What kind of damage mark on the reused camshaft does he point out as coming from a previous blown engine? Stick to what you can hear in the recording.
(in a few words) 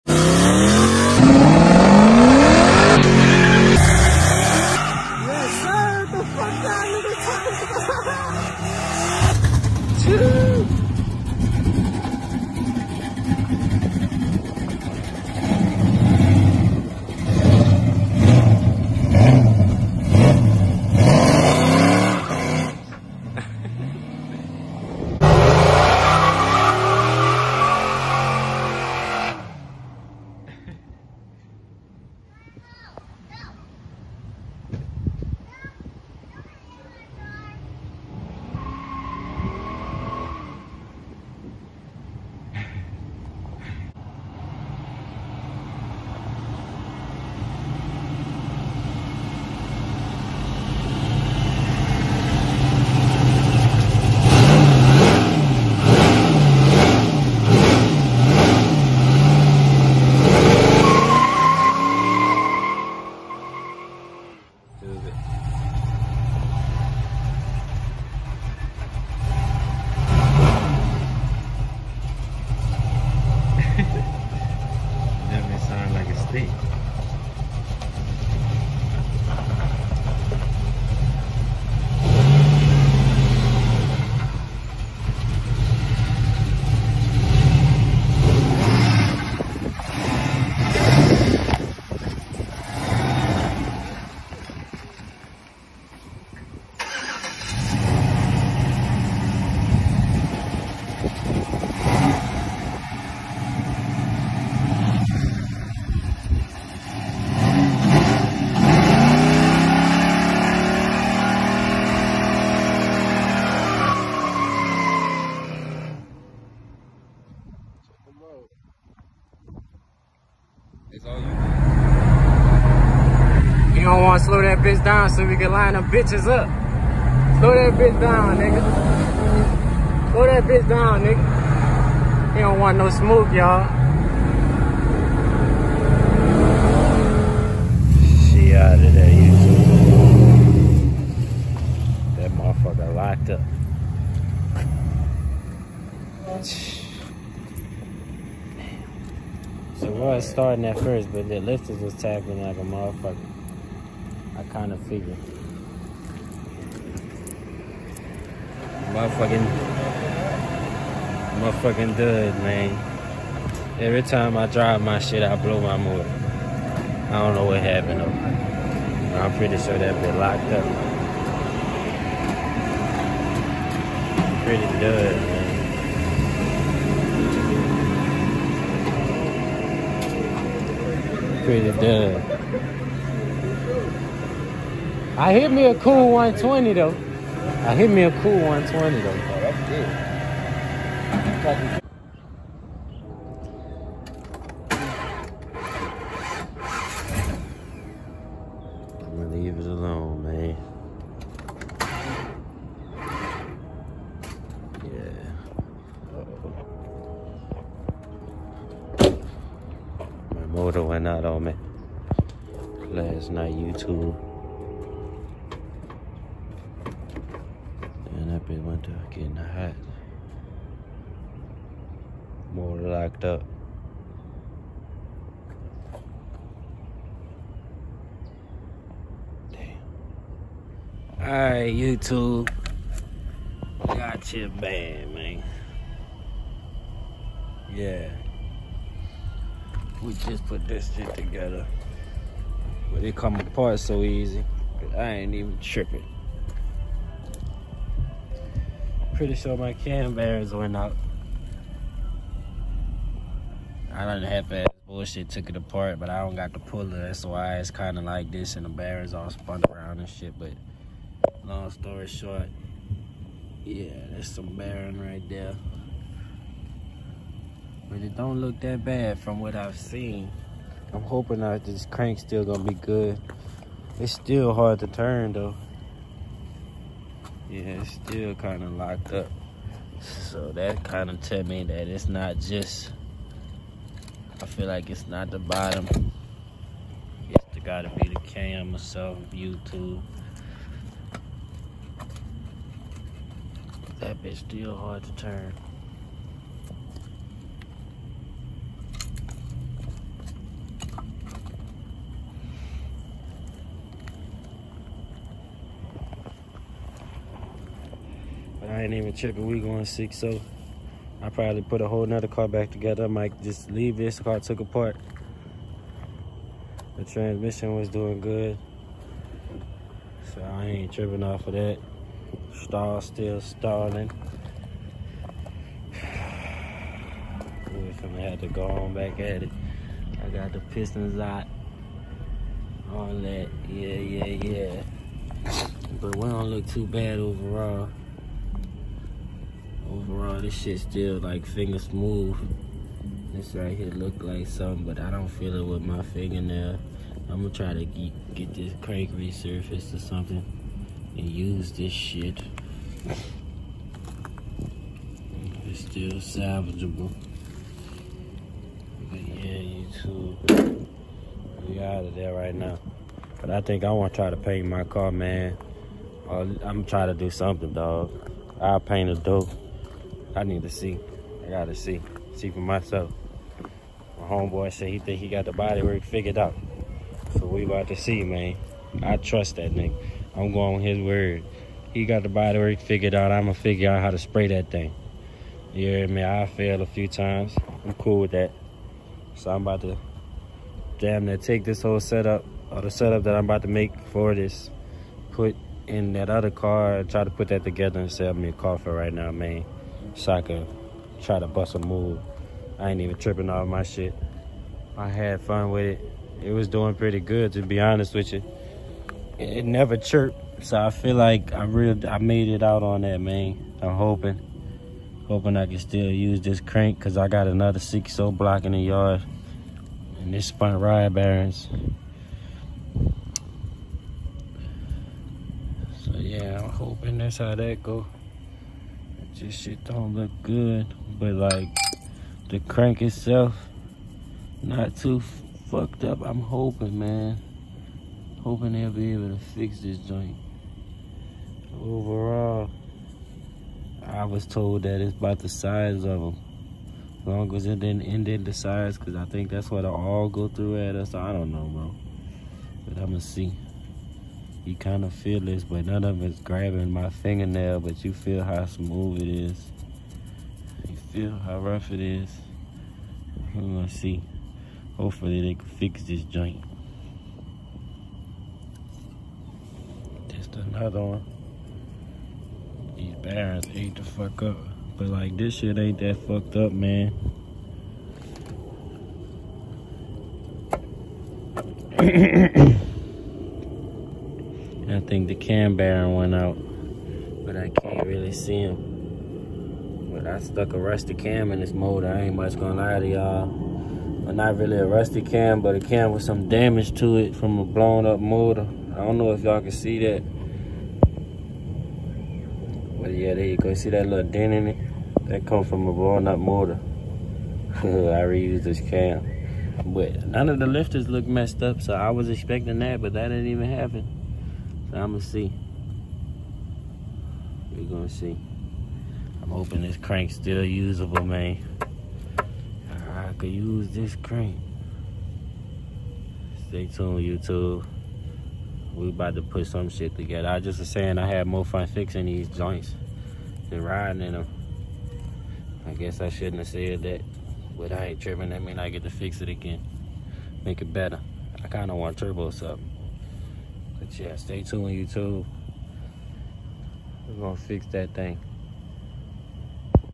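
dent.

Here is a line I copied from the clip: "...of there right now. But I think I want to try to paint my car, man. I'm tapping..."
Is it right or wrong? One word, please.
wrong.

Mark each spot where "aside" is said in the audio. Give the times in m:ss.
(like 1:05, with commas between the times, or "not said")
not said.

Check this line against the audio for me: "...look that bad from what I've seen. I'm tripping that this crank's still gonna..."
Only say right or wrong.
wrong.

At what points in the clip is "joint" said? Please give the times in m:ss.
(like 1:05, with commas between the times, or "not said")
7:19, 7:46, 8:52.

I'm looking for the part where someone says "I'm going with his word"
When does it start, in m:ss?
6:20.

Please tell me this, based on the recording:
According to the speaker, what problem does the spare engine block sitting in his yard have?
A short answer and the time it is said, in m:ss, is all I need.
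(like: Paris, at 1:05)
spun rod bearings, at 7:00.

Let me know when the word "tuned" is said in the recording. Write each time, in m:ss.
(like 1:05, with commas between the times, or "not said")
8:46, 9:04.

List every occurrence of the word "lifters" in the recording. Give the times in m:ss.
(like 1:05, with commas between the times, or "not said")
2:31, 8:30.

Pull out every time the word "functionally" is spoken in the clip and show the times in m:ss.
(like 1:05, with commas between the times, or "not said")
not said.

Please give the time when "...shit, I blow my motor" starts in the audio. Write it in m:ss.
2:44.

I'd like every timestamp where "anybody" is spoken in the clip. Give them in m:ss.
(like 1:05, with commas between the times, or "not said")
not said.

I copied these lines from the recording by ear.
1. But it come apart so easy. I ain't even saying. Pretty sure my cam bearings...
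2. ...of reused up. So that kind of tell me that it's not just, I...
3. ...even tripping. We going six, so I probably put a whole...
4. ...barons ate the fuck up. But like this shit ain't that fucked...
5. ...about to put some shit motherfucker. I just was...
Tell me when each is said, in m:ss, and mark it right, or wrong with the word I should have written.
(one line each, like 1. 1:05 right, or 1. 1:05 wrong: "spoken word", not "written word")
1. 4:02 wrong: "tripping", not "saying"
2. 4:38 wrong: "locked", not "reused"
3. 5:08 right
4. 7:53 right
5. 8:49 wrong: "together", not "motherfucker".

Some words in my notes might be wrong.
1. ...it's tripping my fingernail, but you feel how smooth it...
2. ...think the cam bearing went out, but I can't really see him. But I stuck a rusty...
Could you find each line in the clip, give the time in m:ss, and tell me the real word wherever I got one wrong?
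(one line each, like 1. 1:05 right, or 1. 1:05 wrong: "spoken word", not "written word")
1. 7:36 wrong: "grabbing", not "tripping"
2. 8:05 right.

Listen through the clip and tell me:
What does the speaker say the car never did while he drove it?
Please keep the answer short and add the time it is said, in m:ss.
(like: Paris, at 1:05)
chirped, at 6:49.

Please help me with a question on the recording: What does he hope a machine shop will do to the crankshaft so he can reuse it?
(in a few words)
resurfaced.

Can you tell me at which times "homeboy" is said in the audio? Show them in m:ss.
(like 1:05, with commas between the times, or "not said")
6:14.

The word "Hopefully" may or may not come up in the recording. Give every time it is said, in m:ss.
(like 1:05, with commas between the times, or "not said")
7:44.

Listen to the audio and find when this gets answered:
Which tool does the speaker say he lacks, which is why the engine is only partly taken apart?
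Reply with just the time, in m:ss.
4:16.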